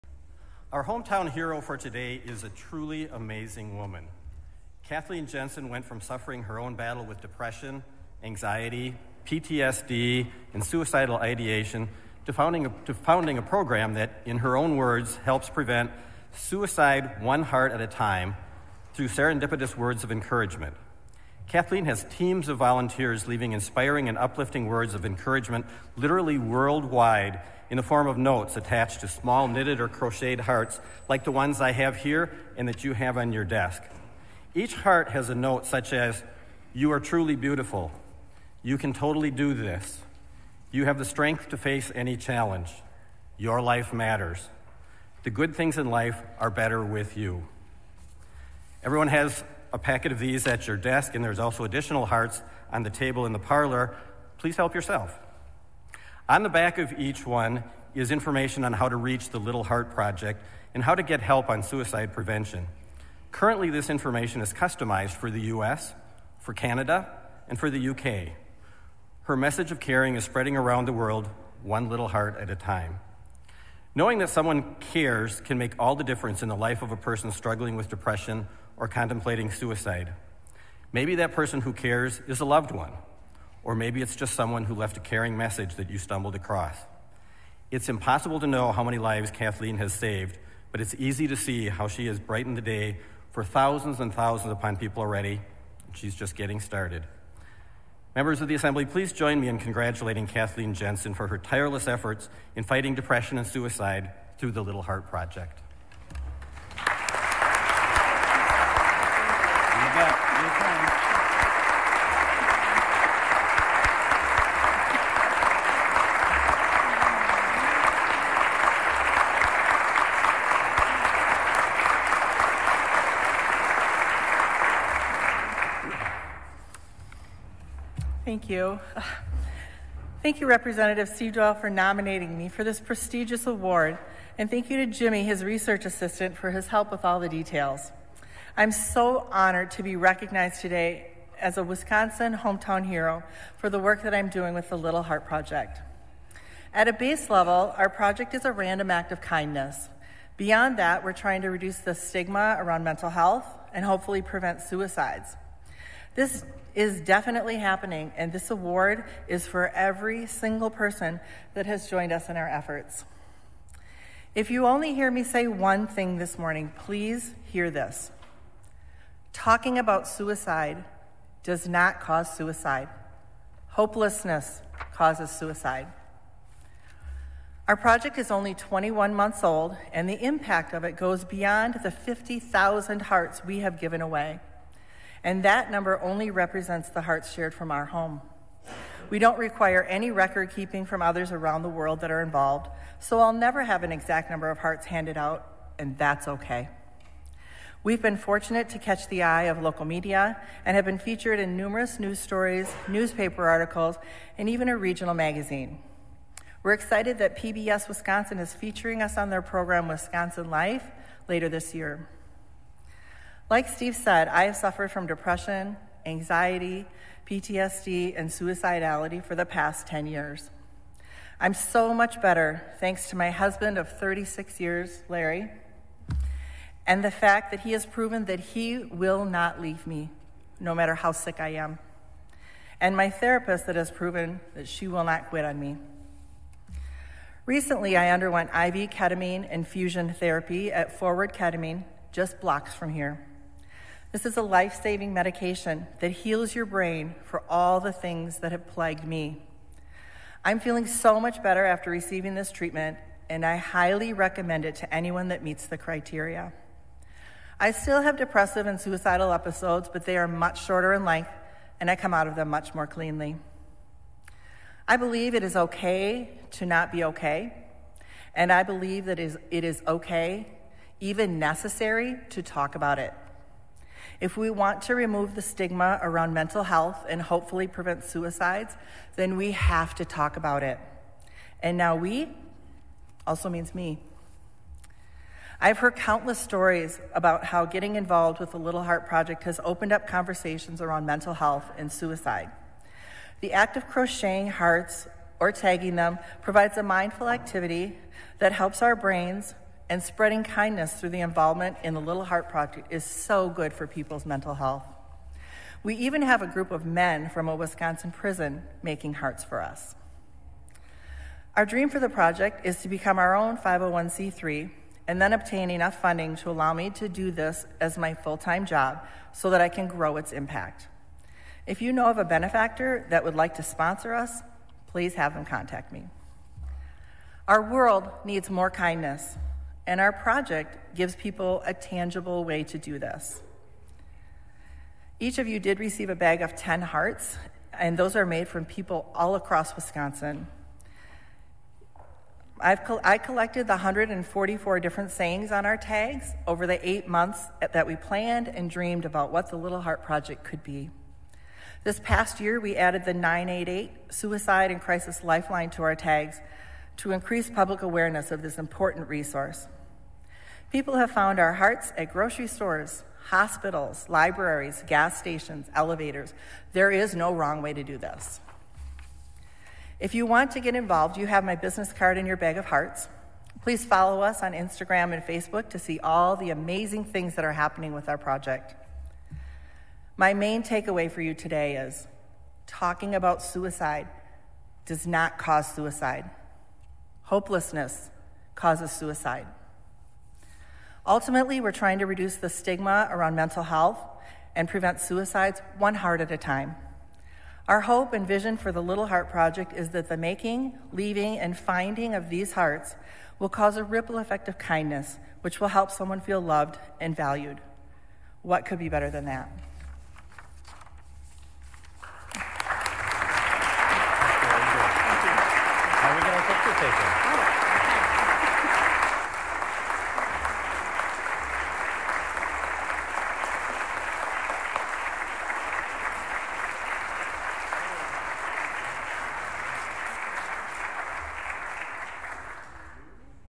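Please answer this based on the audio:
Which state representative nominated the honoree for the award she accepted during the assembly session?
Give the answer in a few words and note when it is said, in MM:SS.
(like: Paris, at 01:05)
Representative Seedwell, at 02:10.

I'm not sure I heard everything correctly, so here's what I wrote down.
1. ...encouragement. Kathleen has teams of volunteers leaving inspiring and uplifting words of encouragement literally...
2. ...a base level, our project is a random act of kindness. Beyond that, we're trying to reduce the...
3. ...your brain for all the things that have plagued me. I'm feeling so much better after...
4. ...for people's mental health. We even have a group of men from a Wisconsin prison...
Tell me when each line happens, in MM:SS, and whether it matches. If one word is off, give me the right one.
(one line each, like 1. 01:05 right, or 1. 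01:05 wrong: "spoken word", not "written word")
1. 00:20 right
2. 02:26 right
3. 04:06 right
4. 05:03 right.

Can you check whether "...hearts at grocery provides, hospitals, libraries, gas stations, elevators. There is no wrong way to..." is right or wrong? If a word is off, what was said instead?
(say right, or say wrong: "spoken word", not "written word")
wrong: "stores", not "provides".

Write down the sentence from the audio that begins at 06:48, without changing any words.
What could be better than that?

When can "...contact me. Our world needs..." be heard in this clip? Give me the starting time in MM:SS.
05:25.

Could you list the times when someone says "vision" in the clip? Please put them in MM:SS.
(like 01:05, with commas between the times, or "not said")
06:38.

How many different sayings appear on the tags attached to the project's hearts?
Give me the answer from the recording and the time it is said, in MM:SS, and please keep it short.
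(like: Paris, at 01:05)
144, at 05:43.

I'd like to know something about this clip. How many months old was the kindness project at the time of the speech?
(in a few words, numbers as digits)
21 months.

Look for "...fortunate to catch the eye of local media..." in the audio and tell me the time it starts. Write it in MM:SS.
03:18.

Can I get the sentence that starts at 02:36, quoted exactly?
This is definitely happening, and this award is for every single person that has joined us in our efforts.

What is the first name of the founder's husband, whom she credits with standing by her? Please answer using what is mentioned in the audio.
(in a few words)
Larry.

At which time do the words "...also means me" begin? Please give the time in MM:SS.
04:43.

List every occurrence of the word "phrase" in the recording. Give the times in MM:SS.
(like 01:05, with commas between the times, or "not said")
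not said.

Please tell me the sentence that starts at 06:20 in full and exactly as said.
My main takeaway for you today is talking about suicide does not cause suicide.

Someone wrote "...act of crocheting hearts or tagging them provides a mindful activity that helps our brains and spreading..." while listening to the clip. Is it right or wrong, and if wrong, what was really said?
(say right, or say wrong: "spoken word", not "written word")
right.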